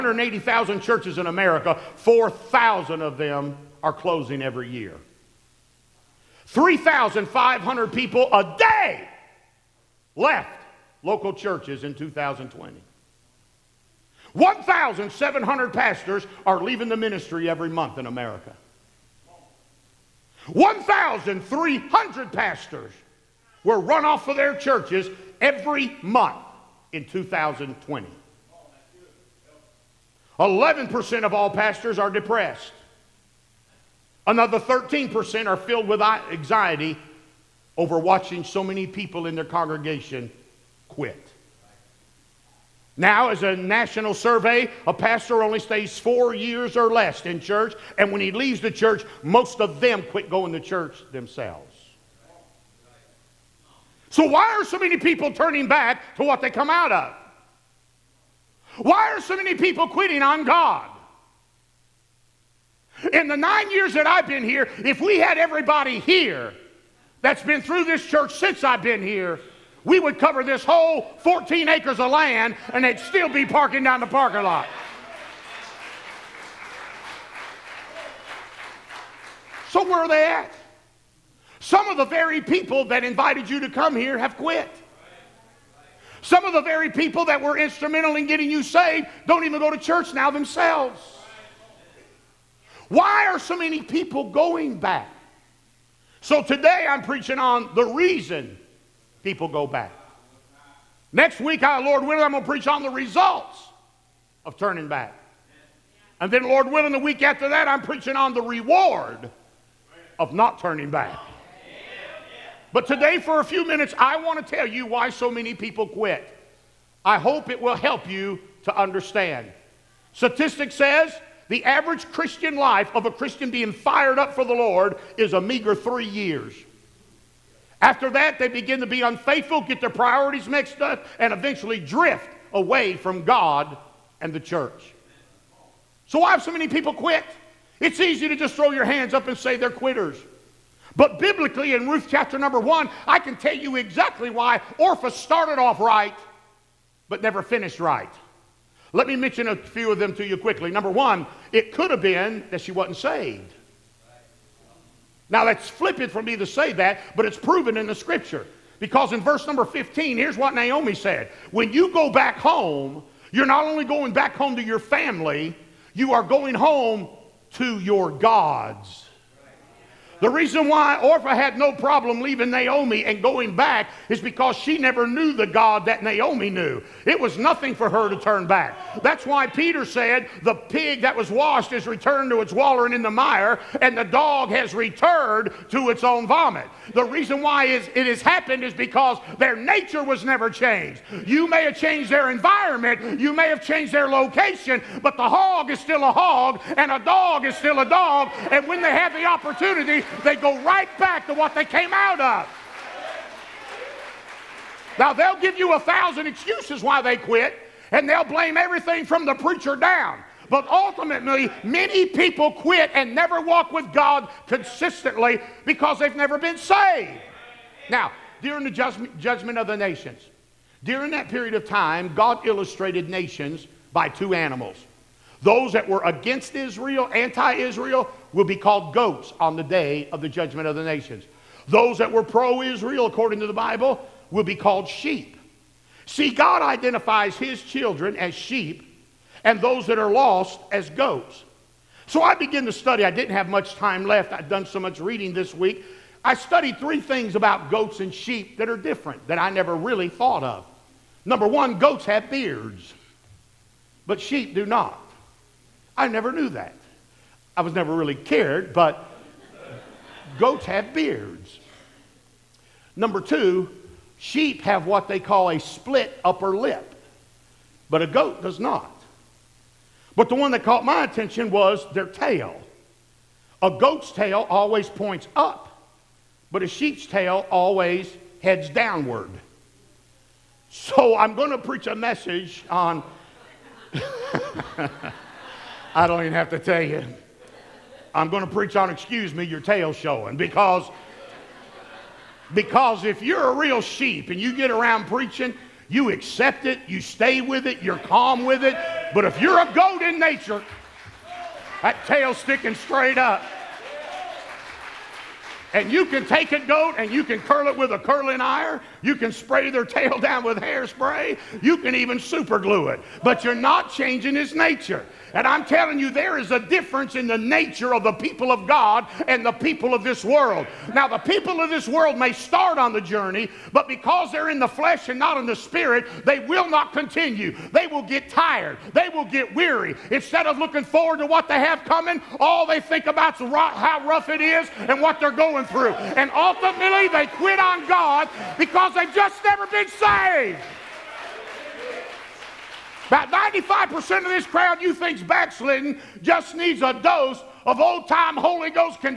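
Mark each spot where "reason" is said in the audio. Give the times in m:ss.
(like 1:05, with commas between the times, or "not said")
1:37, 2:50, 3:07.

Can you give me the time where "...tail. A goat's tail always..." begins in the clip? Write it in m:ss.
4:32.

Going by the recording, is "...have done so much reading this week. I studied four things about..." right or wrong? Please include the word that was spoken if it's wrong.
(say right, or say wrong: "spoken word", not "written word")
wrong: "three", not "four".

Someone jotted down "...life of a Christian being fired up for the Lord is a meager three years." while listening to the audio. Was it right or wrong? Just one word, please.
right.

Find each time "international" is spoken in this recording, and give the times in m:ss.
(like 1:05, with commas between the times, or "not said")
not said.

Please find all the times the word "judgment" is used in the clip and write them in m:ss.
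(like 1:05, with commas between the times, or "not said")
3:39, 3:50.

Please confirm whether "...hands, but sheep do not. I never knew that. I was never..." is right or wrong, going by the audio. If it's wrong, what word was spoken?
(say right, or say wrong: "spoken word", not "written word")
wrong: "beards", not "hands".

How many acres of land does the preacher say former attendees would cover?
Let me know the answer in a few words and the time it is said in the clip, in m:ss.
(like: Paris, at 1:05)
14, at 1:11.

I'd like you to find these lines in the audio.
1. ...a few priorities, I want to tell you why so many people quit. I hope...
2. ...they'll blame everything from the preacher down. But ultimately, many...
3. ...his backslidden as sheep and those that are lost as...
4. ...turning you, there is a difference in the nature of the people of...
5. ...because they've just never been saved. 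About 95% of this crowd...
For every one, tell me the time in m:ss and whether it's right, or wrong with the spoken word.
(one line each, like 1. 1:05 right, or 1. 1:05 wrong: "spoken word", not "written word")
1. 1:53 wrong: "minutes", not "priorities"
2. 3:28 right
3. 3:57 wrong: "children", not "backslidden"
4. 5:15 wrong: "telling", not "turning"
5. 5:38 right.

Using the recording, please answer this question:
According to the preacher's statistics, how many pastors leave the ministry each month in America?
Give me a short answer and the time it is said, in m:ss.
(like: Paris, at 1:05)
1,700, at 0:14.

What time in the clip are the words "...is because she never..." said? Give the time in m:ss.
2:54.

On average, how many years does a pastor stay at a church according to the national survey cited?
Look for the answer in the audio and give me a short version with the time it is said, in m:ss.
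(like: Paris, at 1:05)
4 years or less, at 0:45.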